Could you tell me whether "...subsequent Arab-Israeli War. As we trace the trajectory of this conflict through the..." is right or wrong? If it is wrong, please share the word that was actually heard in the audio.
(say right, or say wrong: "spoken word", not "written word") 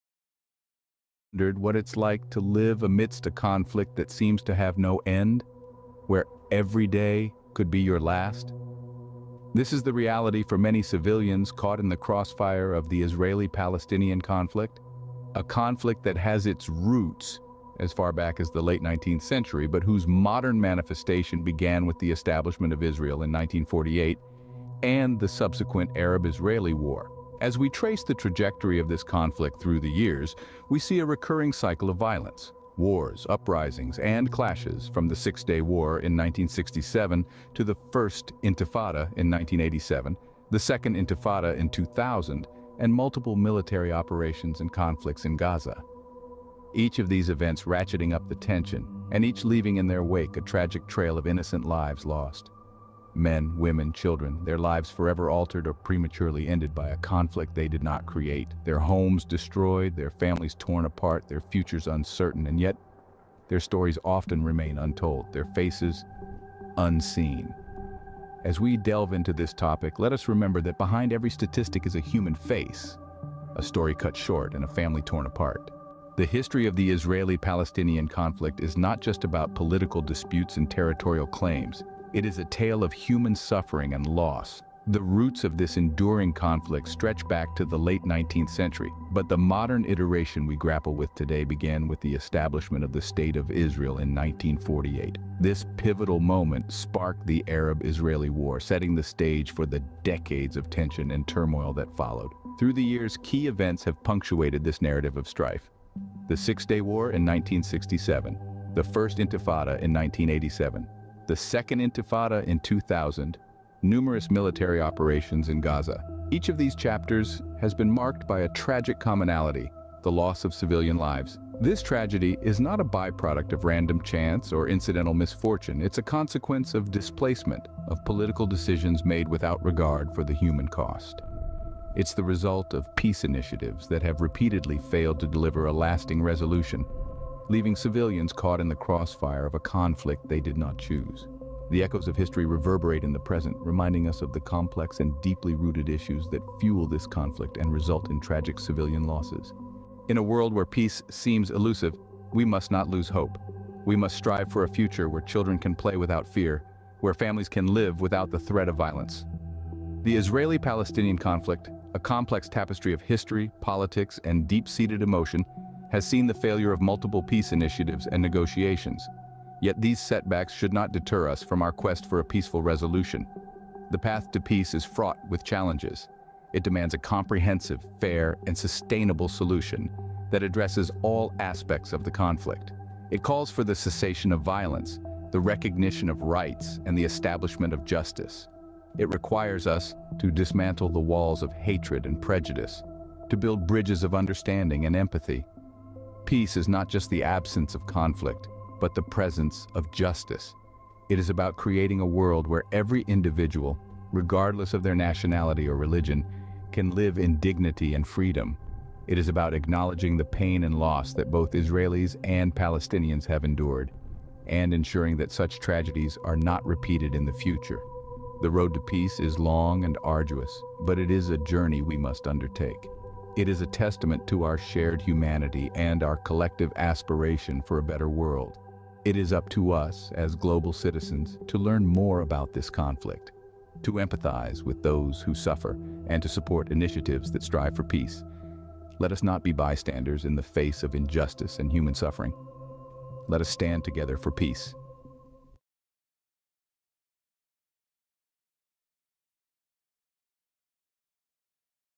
right.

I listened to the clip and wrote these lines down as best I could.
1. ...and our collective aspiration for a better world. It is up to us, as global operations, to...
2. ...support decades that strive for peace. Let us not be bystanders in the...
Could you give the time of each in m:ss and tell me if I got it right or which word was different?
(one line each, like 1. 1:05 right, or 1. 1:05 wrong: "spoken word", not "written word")
1. 3:45 wrong: "citizens", not "operations"
2. 3:56 wrong: "initiatives", not "decades".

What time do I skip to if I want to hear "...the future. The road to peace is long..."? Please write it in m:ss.
3:37.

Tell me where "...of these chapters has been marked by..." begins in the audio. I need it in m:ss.
1:56.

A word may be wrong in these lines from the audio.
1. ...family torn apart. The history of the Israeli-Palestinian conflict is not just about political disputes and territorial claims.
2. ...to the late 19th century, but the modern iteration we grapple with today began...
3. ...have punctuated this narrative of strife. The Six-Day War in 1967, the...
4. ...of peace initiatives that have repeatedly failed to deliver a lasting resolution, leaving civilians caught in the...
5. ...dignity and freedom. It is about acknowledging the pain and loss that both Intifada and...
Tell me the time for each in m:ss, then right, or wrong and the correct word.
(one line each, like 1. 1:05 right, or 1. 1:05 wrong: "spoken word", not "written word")
1. 1:14 right
2. 1:27 right
3. 1:43 right
4. 2:12 right
5. 3:27 wrong: "Israelis", not "Intifada".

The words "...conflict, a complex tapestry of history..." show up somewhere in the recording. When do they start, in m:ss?
2:41.